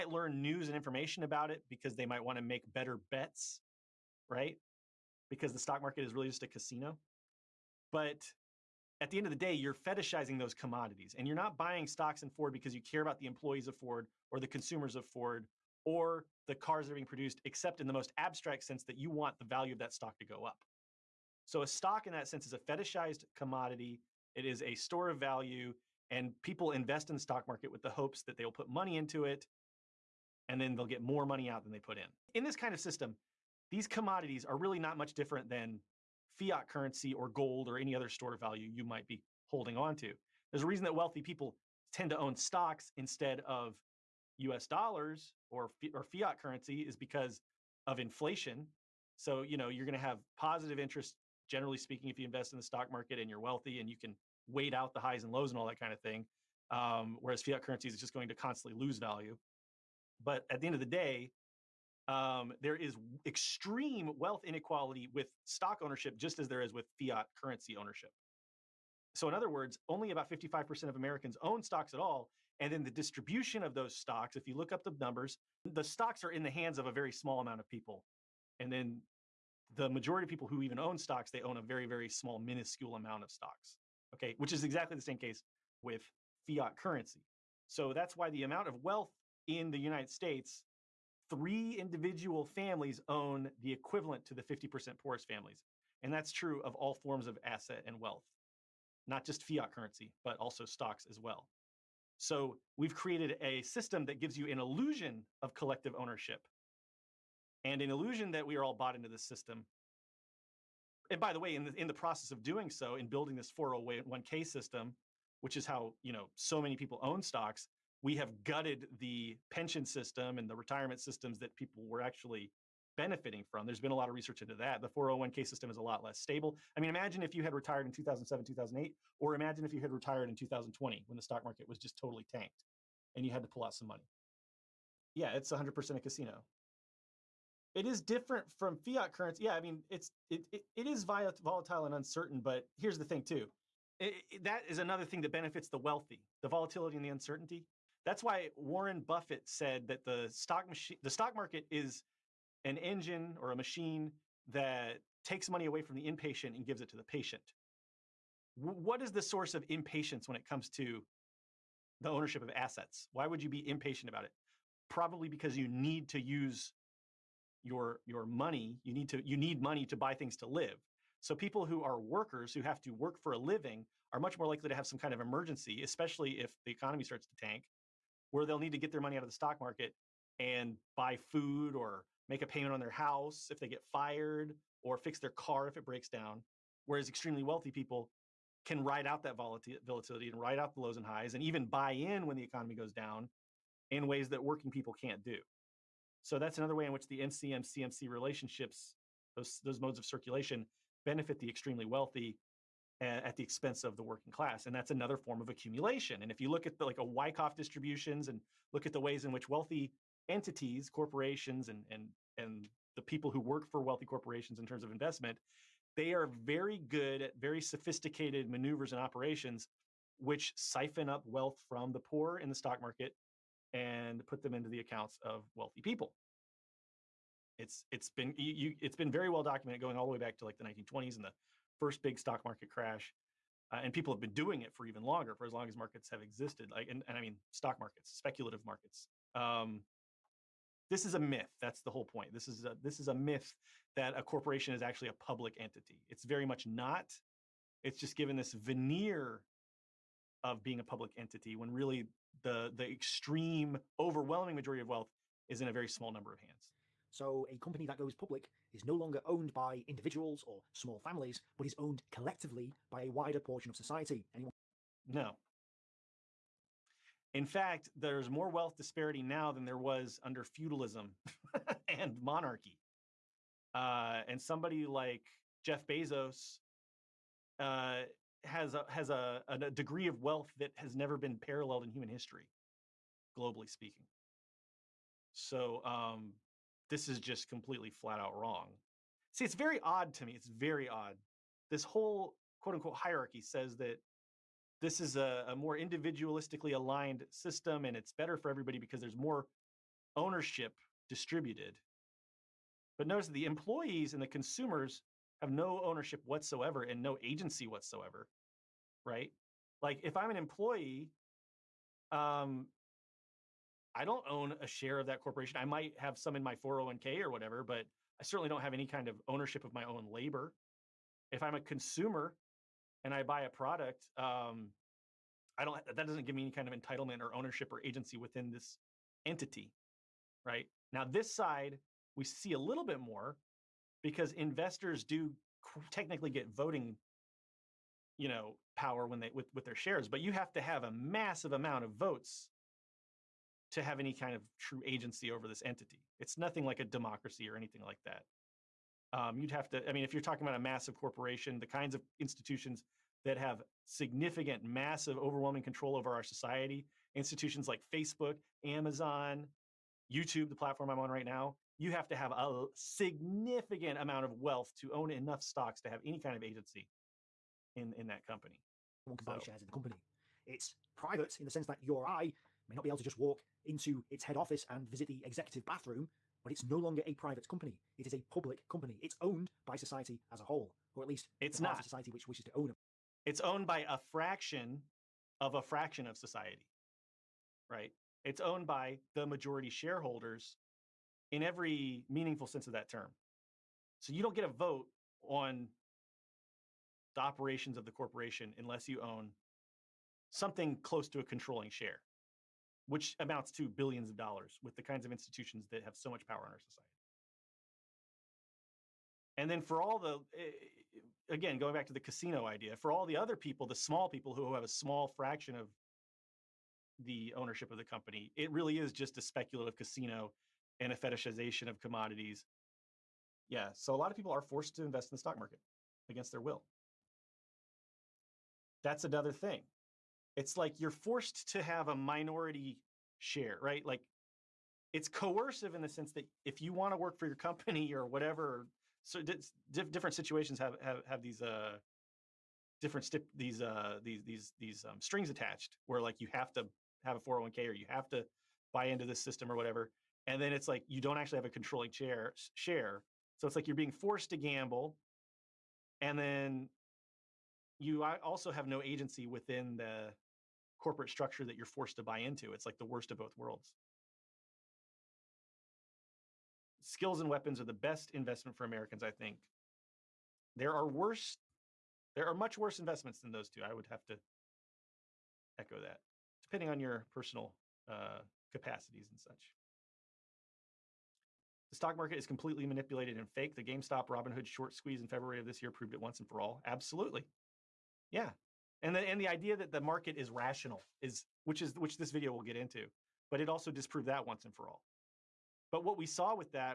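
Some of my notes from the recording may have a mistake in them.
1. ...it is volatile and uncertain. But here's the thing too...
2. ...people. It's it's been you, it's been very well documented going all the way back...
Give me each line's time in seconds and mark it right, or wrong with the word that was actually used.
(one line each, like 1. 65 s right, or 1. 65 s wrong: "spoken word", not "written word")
1. 140 s right
2. 225 s right.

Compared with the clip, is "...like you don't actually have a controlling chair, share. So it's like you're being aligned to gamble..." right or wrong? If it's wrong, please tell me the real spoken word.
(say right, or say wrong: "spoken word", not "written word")
wrong: "forced", not "aligned".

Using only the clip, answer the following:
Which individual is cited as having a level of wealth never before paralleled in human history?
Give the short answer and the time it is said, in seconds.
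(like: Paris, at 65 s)
Jeff Bezos, at 275 s.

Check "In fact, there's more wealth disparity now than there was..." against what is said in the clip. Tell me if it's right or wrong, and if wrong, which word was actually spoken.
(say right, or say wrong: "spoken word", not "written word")
right.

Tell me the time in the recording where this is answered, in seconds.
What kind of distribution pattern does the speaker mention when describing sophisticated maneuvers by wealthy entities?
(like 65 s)
207 s.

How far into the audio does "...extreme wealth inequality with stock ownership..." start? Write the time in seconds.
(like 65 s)
63 s.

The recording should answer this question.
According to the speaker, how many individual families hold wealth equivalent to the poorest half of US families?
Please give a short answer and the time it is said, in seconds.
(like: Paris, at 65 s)
3, at 91 s.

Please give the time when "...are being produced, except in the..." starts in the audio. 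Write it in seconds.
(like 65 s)
16 s.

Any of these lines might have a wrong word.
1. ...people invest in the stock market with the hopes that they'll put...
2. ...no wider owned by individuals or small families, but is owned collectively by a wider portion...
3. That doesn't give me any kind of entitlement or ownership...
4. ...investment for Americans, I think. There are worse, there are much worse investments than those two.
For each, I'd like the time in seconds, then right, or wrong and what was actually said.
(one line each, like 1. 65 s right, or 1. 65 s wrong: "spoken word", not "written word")
1. 26 s right
2. 258 s wrong: "longer", not "wider"
3. 325 s right
4. 468 s right.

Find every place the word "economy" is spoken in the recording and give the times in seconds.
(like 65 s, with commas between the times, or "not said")
176 s, 192 s.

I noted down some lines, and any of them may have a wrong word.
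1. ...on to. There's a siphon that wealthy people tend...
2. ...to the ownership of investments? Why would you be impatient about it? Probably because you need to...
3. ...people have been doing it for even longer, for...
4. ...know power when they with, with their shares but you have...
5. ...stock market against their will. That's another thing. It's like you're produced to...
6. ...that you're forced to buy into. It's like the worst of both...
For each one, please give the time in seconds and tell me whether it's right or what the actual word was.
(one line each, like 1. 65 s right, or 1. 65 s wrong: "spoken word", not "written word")
1. 39 s wrong: "reason", not "siphon"
2. 160 s wrong: "assets", not "investments"
3. 233 s right
4. 338 s right
5. 425 s wrong: "forced", not "produced"
6. 461 s right.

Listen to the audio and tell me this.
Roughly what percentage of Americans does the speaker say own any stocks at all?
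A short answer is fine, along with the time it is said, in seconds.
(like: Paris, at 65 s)
55%, at 70 s.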